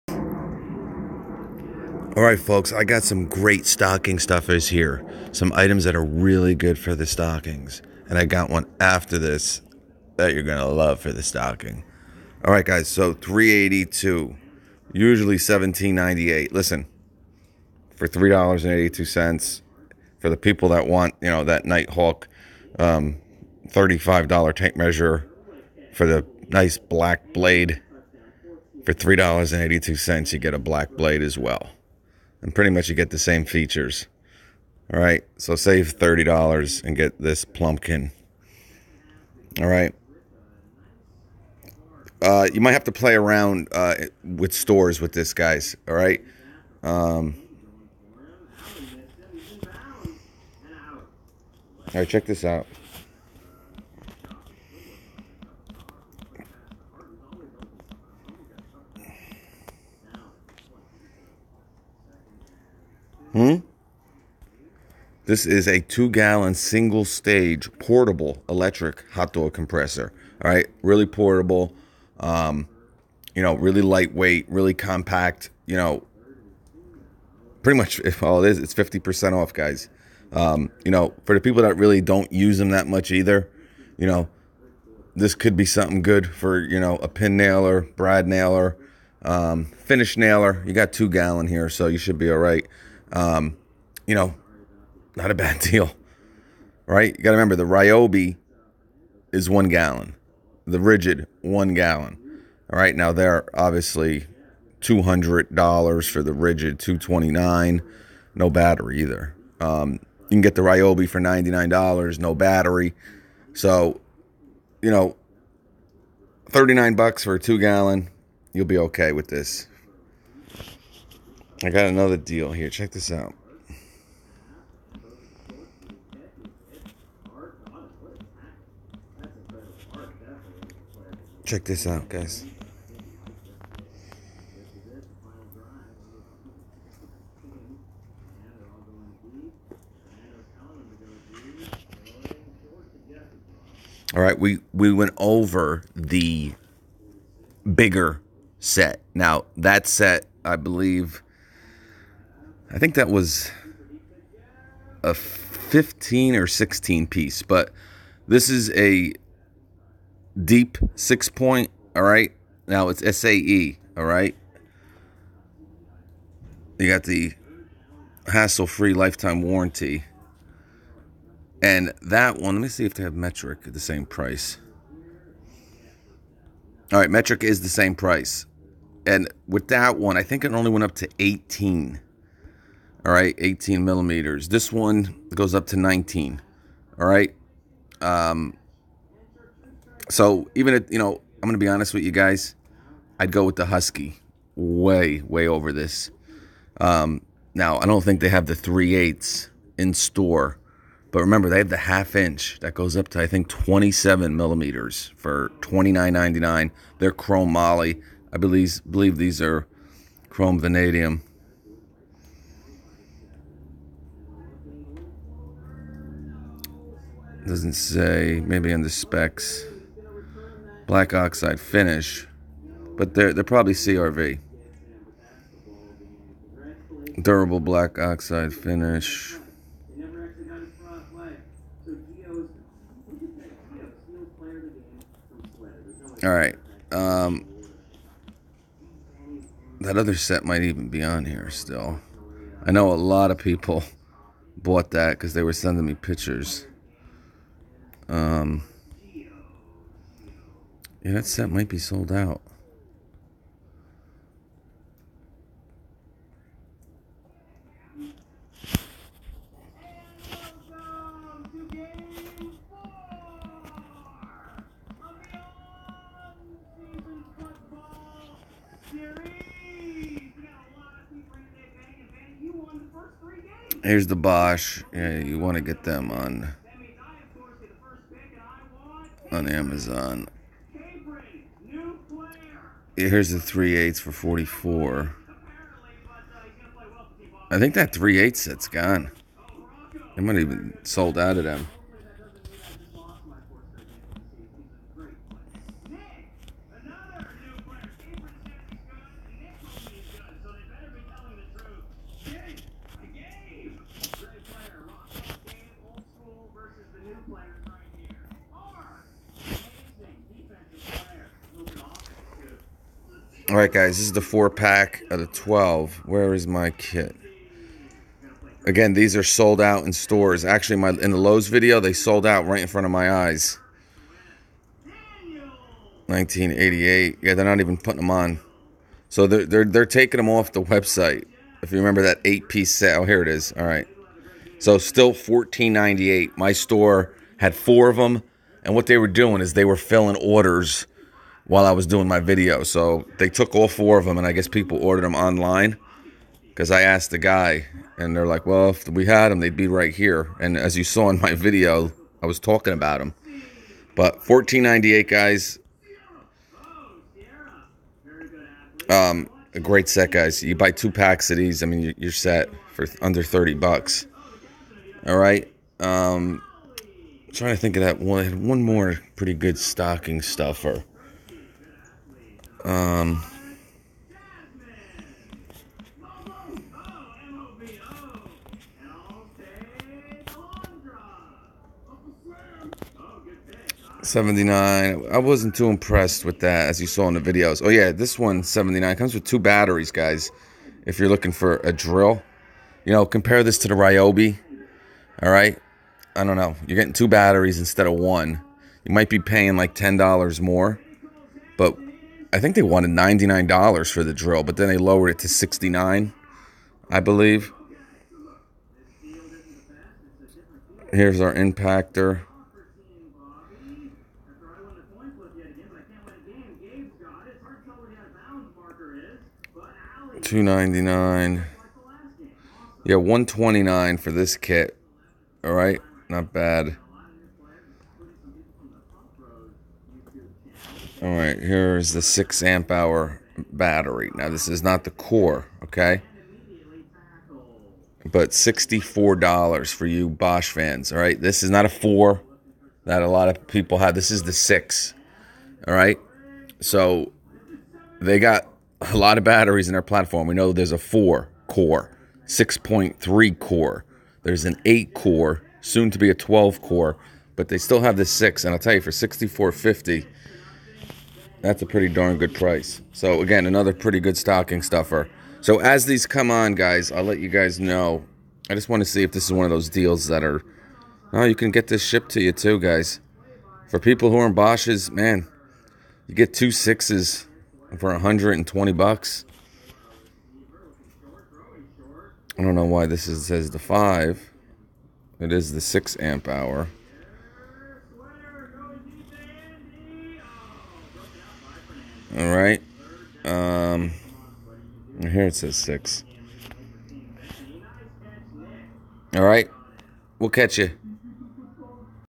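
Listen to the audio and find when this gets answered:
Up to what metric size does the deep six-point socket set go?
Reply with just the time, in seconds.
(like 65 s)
185 s.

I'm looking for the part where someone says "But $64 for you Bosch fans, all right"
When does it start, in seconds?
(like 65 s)
438 s.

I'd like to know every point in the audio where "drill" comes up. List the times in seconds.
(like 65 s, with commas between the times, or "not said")
391 s, 404 s.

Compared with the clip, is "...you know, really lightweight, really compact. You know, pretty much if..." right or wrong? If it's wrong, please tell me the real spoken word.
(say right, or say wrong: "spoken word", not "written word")
right.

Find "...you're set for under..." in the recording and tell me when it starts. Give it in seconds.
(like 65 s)
361 s.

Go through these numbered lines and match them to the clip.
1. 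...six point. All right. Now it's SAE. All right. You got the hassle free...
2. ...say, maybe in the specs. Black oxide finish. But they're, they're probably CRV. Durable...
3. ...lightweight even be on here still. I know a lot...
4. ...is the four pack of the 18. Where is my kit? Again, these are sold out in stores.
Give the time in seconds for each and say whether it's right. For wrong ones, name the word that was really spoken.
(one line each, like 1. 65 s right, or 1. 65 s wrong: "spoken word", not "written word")
1. 160 s right
2. 217 s right
3. 240 s wrong: "might", not "lightweight"
4. 314 s wrong: "12", not "18".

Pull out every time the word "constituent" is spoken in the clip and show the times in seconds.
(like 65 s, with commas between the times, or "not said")
not said.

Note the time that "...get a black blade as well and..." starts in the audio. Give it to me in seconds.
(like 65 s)
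30 s.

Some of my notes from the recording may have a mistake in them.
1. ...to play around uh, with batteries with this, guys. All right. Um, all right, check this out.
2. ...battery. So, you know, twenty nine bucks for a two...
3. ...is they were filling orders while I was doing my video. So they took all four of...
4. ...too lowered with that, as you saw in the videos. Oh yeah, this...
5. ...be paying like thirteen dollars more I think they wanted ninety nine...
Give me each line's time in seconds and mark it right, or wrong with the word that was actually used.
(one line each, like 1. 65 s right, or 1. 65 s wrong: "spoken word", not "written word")
1. 42 s wrong: "stores", not "batteries"
2. 112 s wrong: "thirty", not "twenty"
3. 339 s right
4. 385 s wrong: "impressed", not "lowered"
5. 399 s wrong: "ten", not "thirteen".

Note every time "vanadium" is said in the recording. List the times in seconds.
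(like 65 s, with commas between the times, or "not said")
210 s.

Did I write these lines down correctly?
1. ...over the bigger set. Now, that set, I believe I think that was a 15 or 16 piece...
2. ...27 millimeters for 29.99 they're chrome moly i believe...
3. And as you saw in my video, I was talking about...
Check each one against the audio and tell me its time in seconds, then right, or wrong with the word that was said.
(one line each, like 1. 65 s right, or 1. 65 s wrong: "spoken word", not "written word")
1. 145 s right
2. 203 s right
3. 350 s right.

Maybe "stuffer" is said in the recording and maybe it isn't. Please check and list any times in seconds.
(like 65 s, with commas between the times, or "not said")
4 s, 370 s, 464 s.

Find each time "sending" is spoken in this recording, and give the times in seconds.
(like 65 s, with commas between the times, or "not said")
245 s.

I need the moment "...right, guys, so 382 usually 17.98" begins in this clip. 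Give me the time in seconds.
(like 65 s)
12 s.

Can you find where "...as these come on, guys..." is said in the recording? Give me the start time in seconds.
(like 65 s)
465 s.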